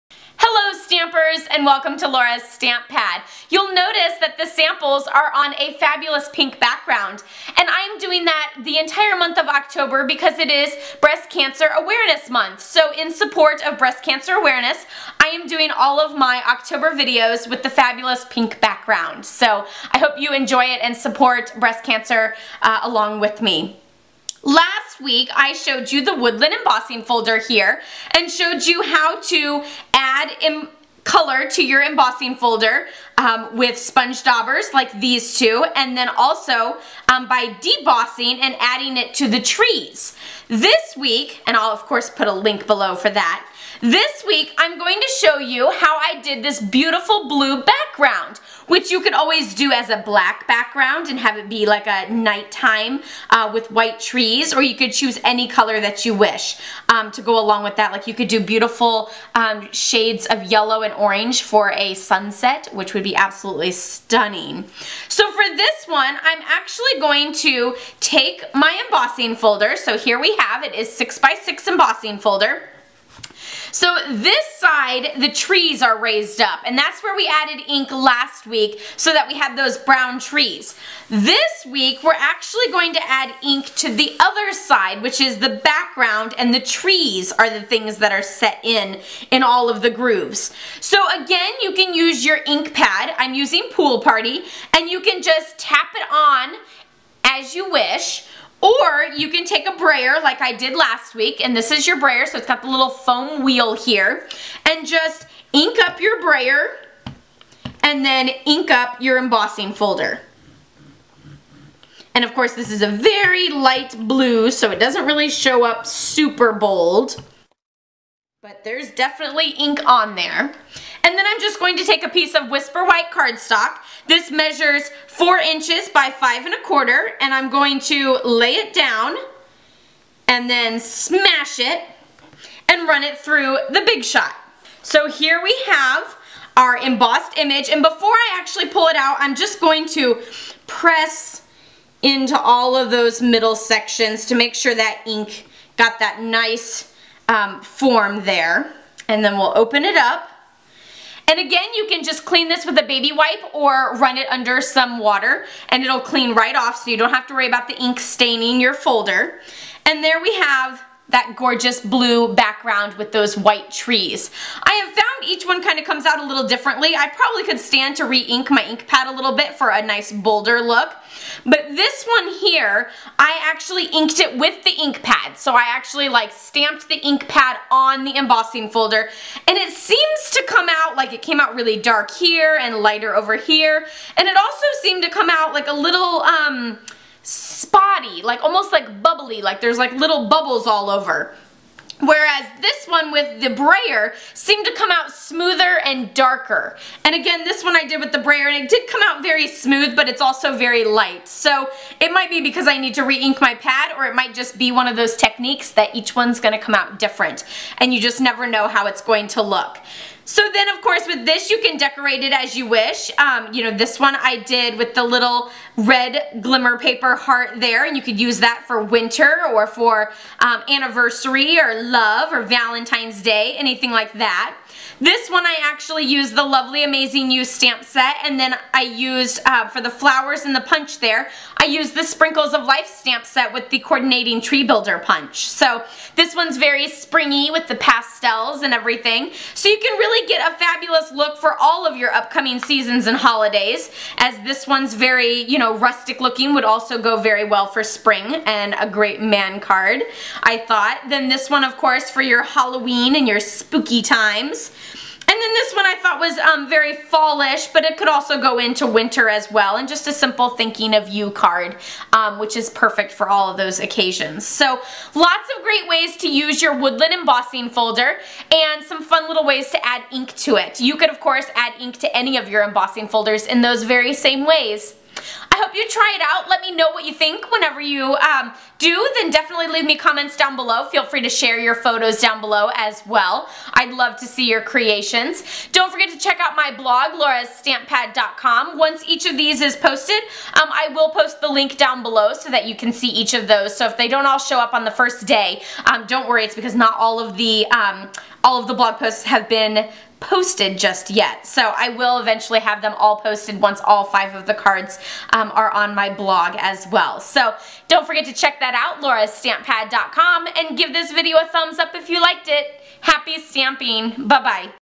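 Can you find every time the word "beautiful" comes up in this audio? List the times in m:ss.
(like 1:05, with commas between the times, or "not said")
0:46, 0:58.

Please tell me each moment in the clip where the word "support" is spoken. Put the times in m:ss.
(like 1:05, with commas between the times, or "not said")
0:13, 0:20.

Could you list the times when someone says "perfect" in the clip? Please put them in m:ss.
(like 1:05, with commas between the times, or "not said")
4:22.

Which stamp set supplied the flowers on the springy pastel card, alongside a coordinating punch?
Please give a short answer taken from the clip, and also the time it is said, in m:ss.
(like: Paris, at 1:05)
Sprinkles of Life, at 3:52.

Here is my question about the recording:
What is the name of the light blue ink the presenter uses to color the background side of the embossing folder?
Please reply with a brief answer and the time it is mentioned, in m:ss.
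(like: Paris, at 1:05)
Pool Party, at 1:33.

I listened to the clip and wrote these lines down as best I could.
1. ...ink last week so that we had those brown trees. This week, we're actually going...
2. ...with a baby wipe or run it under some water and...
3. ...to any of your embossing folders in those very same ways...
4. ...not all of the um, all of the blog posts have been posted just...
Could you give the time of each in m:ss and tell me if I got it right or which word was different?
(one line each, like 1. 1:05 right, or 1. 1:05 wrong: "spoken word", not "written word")
1. 1:17 right
2. 2:32 right
3. 4:31 right
4. 4:56 right.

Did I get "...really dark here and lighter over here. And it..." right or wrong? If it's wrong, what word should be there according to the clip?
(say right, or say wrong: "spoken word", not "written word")
right.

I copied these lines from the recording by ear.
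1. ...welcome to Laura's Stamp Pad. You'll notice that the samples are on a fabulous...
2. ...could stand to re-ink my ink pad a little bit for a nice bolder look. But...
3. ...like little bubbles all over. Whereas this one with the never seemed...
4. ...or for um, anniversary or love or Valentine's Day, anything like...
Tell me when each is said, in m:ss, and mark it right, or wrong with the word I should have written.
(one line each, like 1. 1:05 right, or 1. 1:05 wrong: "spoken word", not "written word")
1. 0:01 right
2. 2:47 right
3. 3:09 wrong: "brayer", not "never"
4. 3:39 right.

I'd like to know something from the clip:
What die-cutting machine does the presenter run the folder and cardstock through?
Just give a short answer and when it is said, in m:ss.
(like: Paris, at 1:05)
Big Shot, at 2:13.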